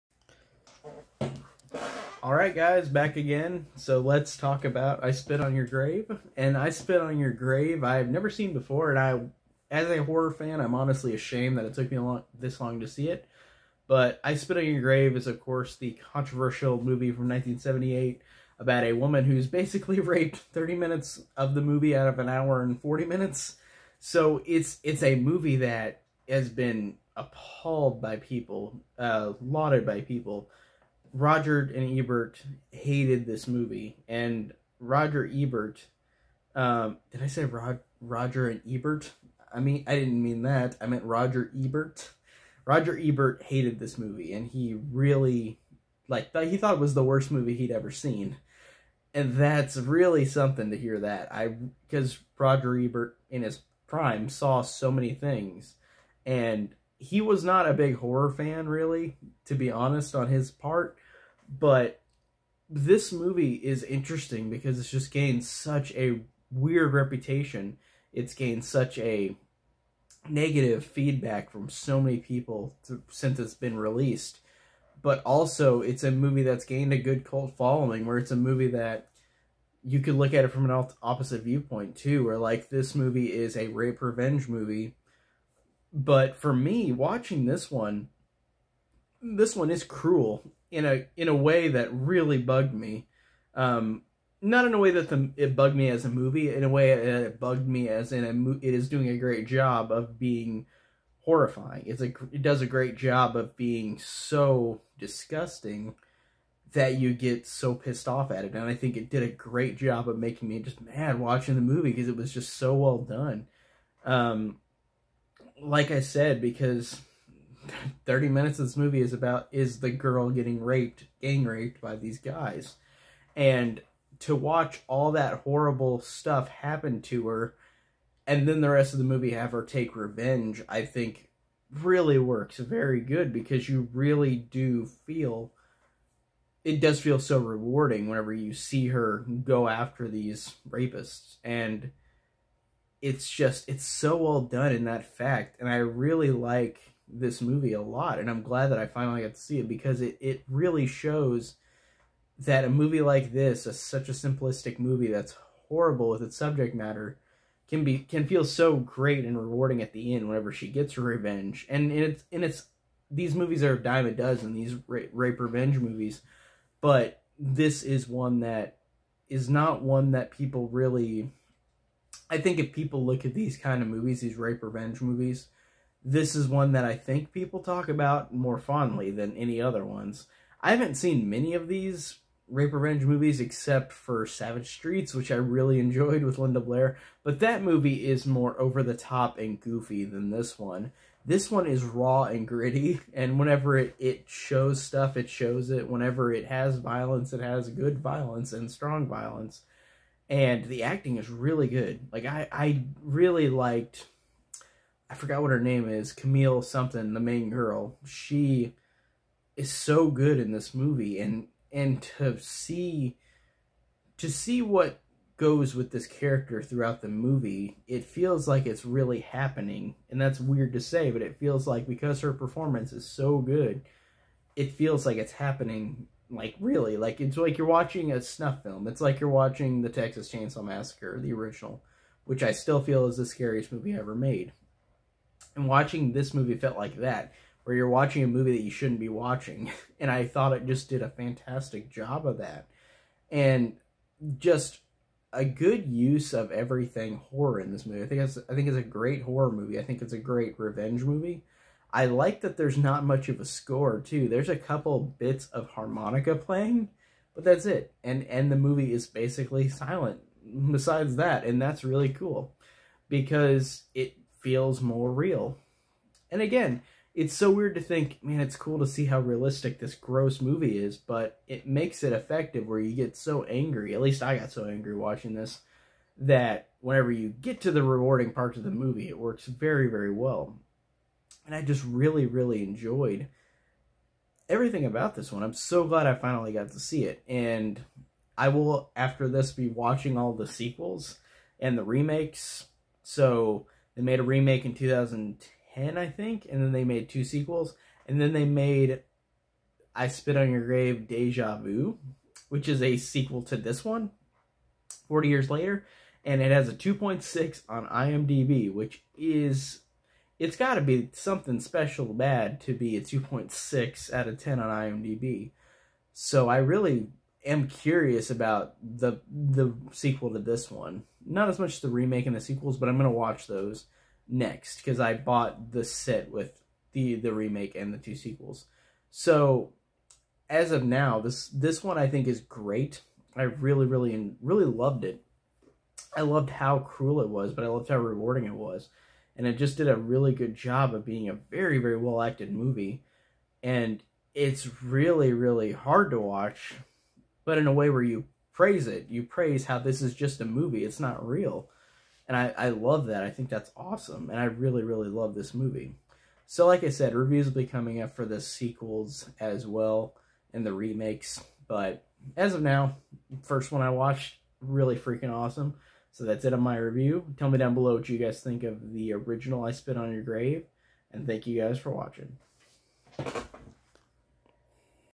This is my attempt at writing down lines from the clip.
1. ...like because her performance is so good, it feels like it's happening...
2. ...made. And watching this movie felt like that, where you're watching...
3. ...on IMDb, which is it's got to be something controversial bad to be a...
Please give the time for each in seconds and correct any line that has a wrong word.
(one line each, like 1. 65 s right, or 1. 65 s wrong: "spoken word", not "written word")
1. 221 s right
2. 234 s right
3. 307 s wrong: "special", not "controversial".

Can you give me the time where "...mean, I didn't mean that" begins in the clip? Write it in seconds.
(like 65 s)
39 s.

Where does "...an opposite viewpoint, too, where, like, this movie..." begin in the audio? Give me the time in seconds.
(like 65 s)
80 s.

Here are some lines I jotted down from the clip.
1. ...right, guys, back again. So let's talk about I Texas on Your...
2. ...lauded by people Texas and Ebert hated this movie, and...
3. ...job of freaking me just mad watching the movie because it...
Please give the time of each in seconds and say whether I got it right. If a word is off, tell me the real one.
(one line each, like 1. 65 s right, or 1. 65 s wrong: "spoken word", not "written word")
1. 2 s wrong: "Spit", not "Texas"
2. 29 s wrong: "Roger", not "Texas"
3. 109 s wrong: "making", not "freaking".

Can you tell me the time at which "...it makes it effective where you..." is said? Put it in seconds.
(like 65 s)
271 s.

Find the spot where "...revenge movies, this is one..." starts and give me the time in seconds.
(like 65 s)
174 s.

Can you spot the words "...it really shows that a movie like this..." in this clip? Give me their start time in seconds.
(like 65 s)
150 s.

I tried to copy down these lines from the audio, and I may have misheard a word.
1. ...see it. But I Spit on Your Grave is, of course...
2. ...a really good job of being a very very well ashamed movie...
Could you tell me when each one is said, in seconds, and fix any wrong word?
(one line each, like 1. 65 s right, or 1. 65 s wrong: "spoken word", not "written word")
1. 12 s right
2. 339 s wrong: "acted", not "ashamed".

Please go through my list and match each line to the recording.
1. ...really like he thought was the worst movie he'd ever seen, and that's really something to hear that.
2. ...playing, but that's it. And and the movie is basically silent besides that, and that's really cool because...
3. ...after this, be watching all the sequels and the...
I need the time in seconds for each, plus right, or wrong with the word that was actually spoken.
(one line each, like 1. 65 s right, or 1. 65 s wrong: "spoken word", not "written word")
1. 44 s right
2. 256 s right
3. 288 s right.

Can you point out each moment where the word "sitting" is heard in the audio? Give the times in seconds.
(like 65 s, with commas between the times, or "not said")
not said.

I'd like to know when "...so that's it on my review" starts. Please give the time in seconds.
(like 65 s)
366 s.